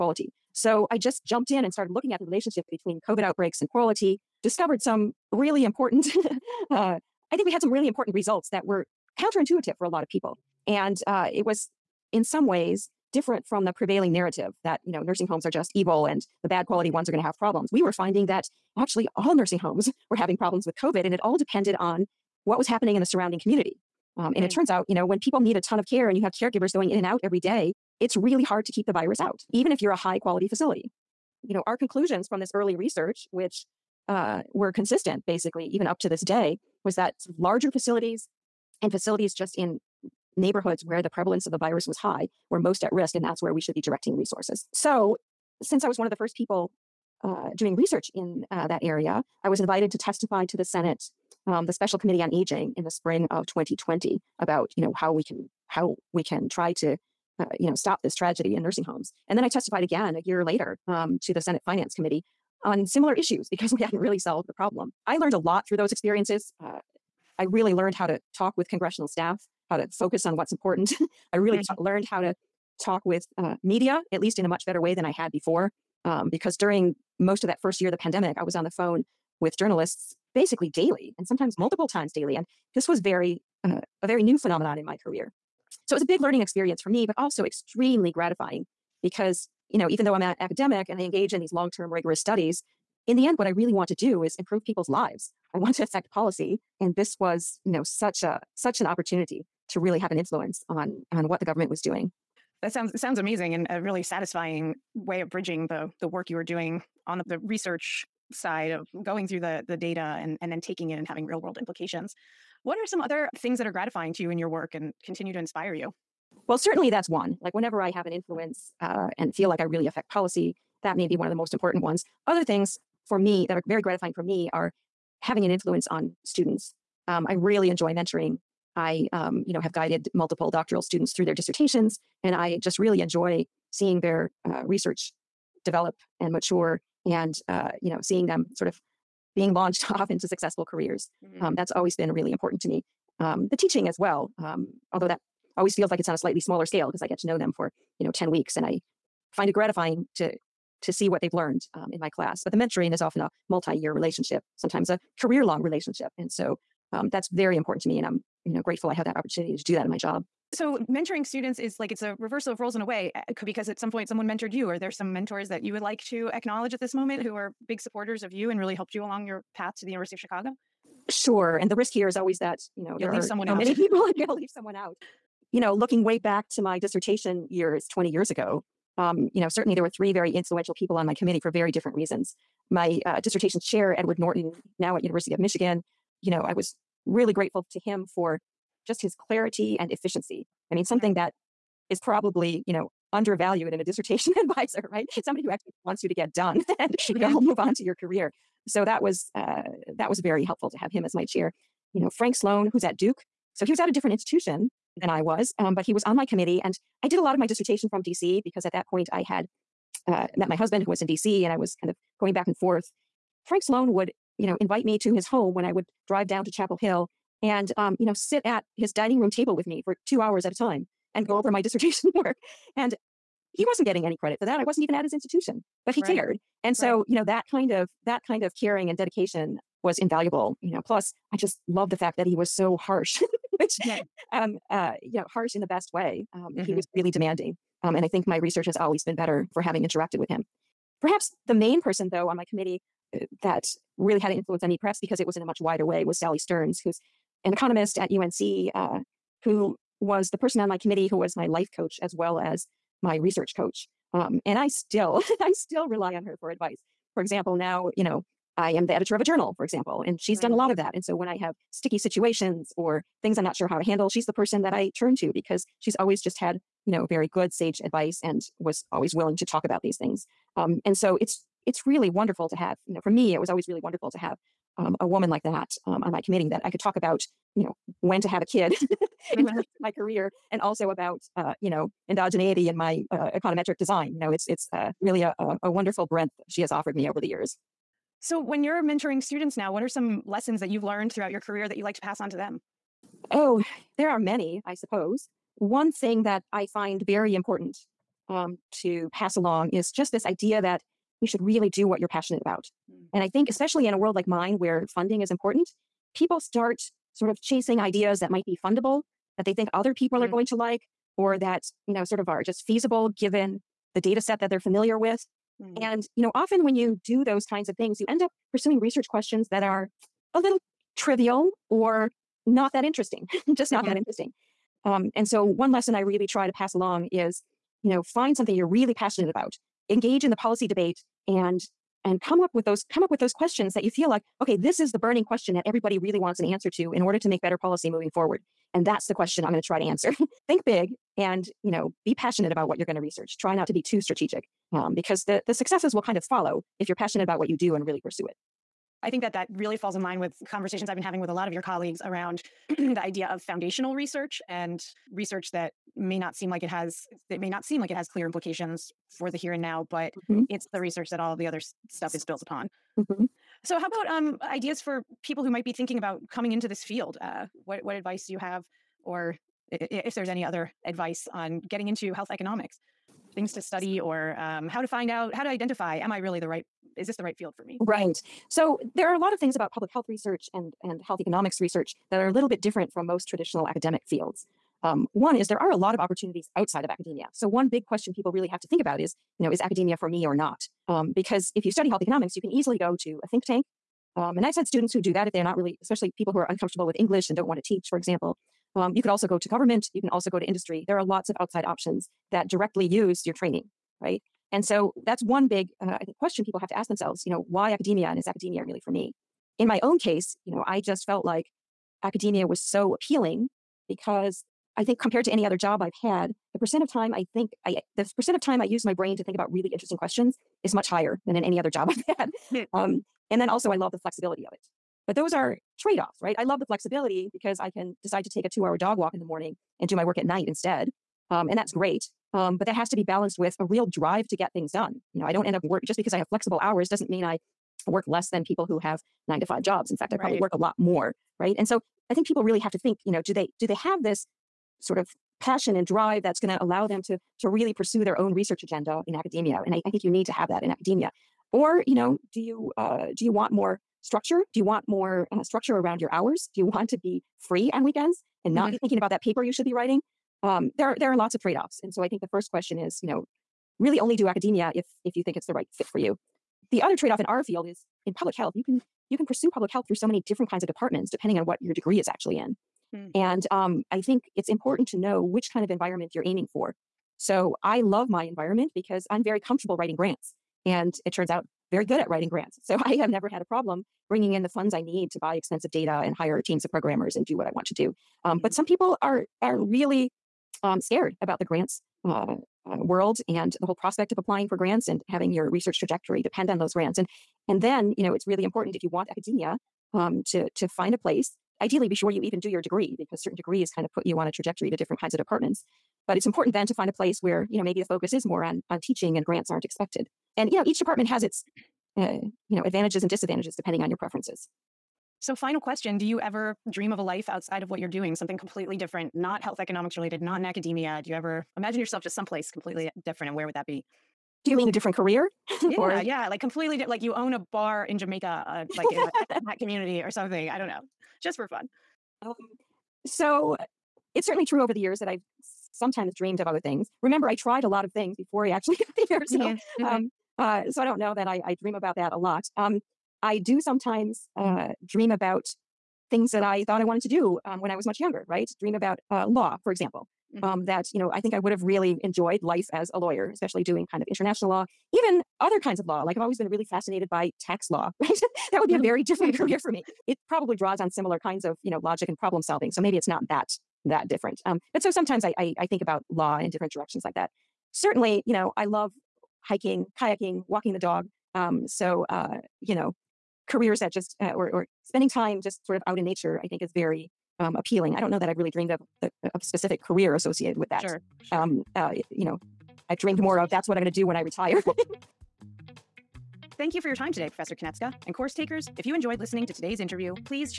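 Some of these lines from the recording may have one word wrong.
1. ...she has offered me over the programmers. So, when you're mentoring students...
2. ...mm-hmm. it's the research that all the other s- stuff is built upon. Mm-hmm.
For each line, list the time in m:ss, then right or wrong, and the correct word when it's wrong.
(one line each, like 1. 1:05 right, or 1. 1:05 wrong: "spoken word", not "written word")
1. 4:46 wrong: "years", not "programmers"
2. 6:00 right.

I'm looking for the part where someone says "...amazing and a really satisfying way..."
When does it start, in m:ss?
1:43.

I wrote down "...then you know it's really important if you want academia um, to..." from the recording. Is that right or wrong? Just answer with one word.
right.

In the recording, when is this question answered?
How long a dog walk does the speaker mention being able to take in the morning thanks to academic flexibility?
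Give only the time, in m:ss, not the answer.
7:08.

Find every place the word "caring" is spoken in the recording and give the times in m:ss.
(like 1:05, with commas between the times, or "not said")
3:48.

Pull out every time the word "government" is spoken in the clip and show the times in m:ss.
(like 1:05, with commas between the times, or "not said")
1:41, 6:39.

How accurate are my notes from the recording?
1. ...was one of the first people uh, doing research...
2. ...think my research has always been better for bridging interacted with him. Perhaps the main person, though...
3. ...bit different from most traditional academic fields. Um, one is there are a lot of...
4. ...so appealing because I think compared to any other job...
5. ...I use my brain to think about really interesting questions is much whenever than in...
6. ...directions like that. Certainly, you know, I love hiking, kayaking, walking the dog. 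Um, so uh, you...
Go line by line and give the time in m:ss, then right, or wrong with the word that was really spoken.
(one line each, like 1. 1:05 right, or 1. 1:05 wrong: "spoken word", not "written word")
1. 0:45 right
2. 3:58 wrong: "having", not "bridging"
3. 6:22 right
4. 6:52 right
5. 6:58 wrong: "higher", not "whenever"
6. 9:26 right.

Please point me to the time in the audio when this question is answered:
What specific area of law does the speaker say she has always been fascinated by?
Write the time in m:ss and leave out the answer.
9:17.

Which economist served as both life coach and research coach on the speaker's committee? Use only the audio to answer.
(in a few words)
Sally Stearns.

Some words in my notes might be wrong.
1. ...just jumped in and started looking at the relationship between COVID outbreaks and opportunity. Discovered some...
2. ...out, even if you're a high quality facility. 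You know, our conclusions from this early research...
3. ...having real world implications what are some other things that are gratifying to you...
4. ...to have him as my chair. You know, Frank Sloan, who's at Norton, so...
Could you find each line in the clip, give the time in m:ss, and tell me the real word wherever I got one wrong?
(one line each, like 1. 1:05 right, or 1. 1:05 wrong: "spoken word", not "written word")
1. 0:00 wrong: "quality", not "opportunity"
2. 0:29 right
3. 1:51 right
4. 3:20 wrong: "Duke", not "Norton".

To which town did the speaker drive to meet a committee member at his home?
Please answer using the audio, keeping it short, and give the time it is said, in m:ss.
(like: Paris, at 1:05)
Chapel Hill, at 3:36.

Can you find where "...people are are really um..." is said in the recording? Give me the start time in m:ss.
8:08.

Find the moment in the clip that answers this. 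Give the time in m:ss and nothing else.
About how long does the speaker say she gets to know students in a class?
2:28.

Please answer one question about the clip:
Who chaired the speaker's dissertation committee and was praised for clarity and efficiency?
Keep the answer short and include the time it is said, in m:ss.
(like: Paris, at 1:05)
Edward Norton, at 3:03.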